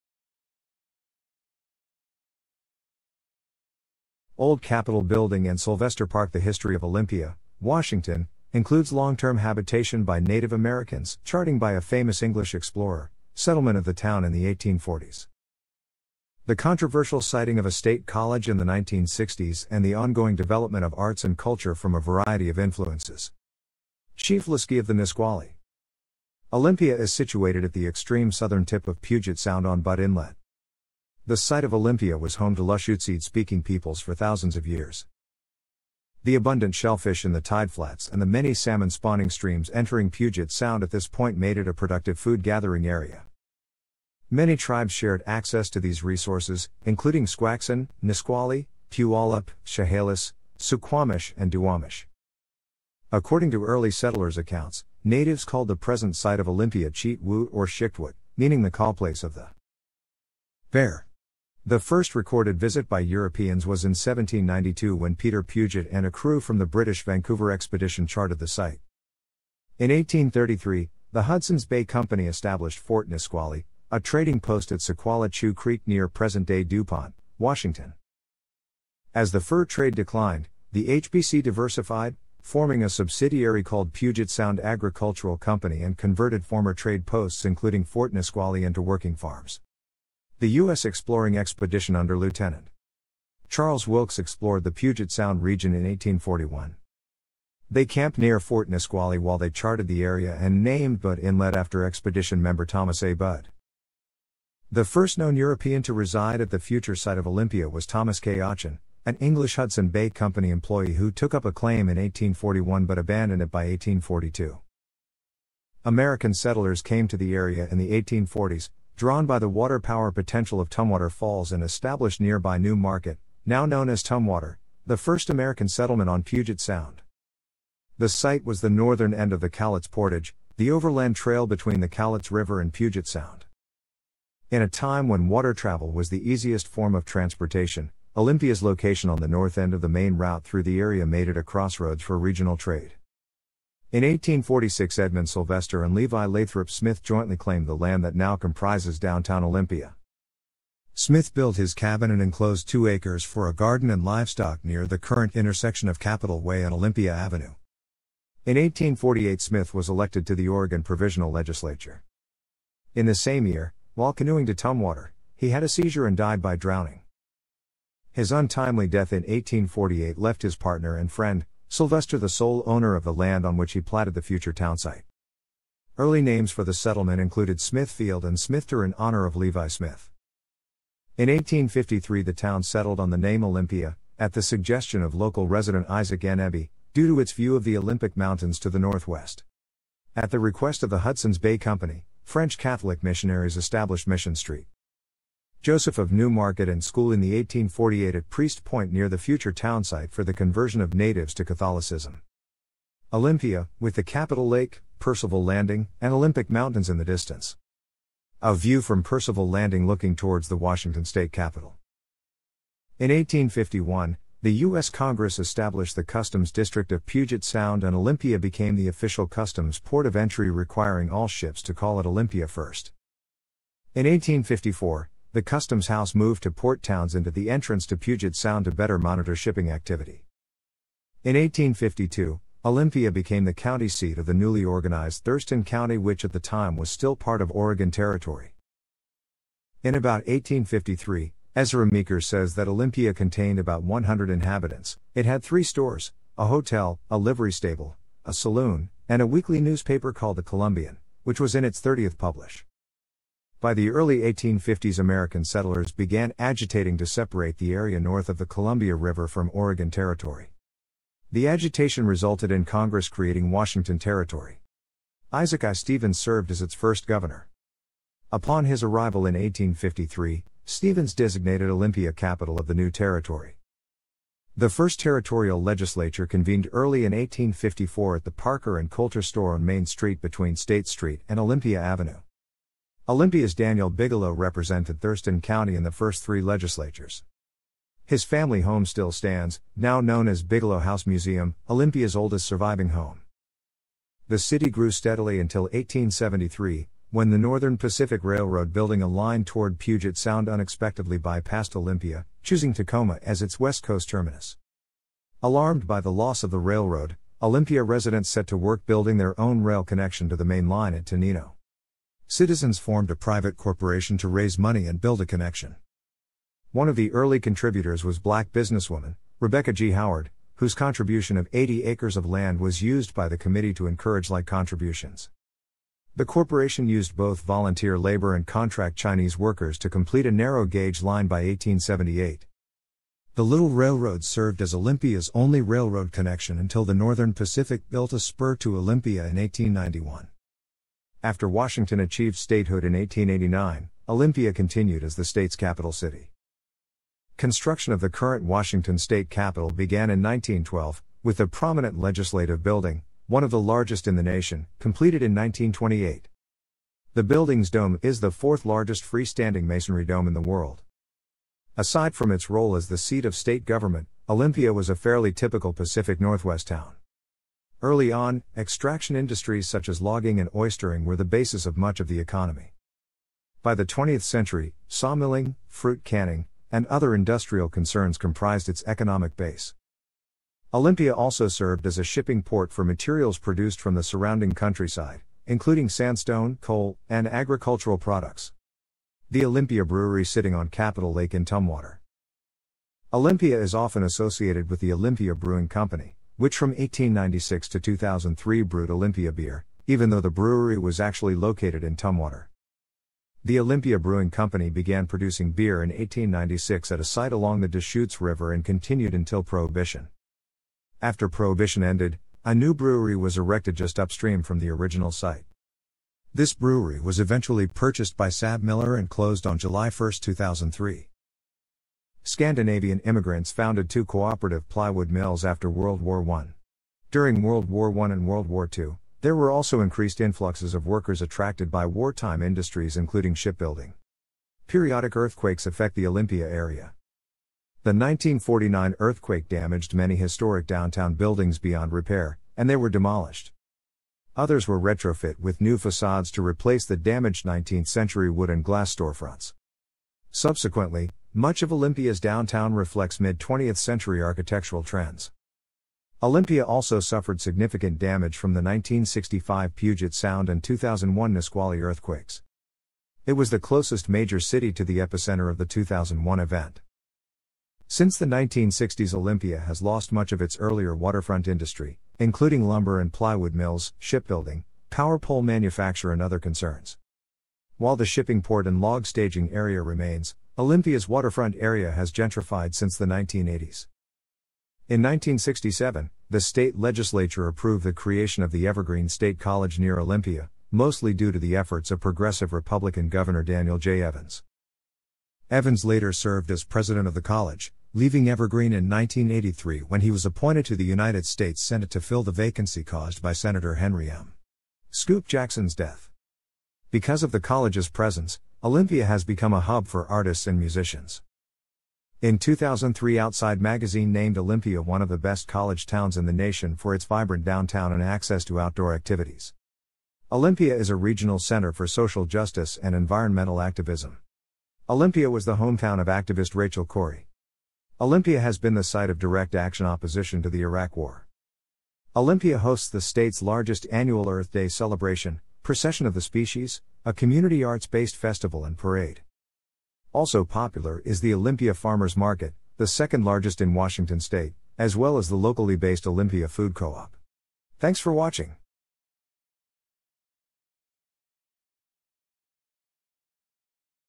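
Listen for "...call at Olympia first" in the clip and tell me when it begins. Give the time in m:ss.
3:41.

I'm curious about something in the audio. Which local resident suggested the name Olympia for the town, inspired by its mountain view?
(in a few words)
Isaac N. Eby.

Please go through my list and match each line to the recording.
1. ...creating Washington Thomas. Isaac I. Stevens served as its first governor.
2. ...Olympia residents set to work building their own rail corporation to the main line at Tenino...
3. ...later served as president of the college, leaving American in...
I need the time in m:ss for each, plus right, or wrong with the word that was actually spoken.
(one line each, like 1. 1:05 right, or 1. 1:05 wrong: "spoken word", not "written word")
1. 4:23 wrong: "Territory", not "Thomas"
2. 5:07 wrong: "connection", not "corporation"
3. 8:15 wrong: "Evergreen", not "American".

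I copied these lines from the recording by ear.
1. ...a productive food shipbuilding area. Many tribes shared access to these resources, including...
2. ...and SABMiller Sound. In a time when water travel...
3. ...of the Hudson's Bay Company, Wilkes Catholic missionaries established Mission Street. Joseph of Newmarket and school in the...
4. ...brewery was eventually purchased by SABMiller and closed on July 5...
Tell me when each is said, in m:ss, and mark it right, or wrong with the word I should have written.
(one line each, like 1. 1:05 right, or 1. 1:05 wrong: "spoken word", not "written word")
1. 0:41 wrong: "gathering", not "shipbuilding"
2. 2:12 wrong: "Puget", not "SABMiller"
3. 3:10 wrong: "French", not "Wilkes"
4. 6:56 wrong: "1", not "5".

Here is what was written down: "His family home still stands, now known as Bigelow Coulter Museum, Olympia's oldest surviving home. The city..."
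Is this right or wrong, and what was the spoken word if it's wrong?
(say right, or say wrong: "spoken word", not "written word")
wrong: "House", not "Coulter".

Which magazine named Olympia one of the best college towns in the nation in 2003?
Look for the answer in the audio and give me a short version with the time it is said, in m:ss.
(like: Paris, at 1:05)
Outside, at 8:33.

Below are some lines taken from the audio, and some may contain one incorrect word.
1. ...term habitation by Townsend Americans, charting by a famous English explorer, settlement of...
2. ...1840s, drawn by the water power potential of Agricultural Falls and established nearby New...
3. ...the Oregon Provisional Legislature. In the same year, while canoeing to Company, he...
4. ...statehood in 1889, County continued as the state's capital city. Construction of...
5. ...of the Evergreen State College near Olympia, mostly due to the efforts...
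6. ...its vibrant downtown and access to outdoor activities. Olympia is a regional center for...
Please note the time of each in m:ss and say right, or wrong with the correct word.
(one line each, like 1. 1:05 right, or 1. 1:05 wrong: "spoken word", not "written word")
1. 0:09 wrong: "Native", not "Townsend"
2. 1:58 wrong: "Tumwater", not "Agricultural"
3. 2:40 wrong: "Tumwater", not "Company"
4. 5:42 wrong: "Olympia", not "County"
5. 8:08 right
6. 8:36 right.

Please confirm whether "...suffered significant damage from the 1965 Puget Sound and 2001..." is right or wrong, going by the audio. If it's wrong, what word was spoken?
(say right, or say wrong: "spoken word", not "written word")
right.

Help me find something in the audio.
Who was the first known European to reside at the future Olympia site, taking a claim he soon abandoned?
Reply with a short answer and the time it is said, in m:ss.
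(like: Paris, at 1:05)
Thomas K. Auchin, at 1:47.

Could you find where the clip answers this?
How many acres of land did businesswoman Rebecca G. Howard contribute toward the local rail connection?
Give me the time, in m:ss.
5:21.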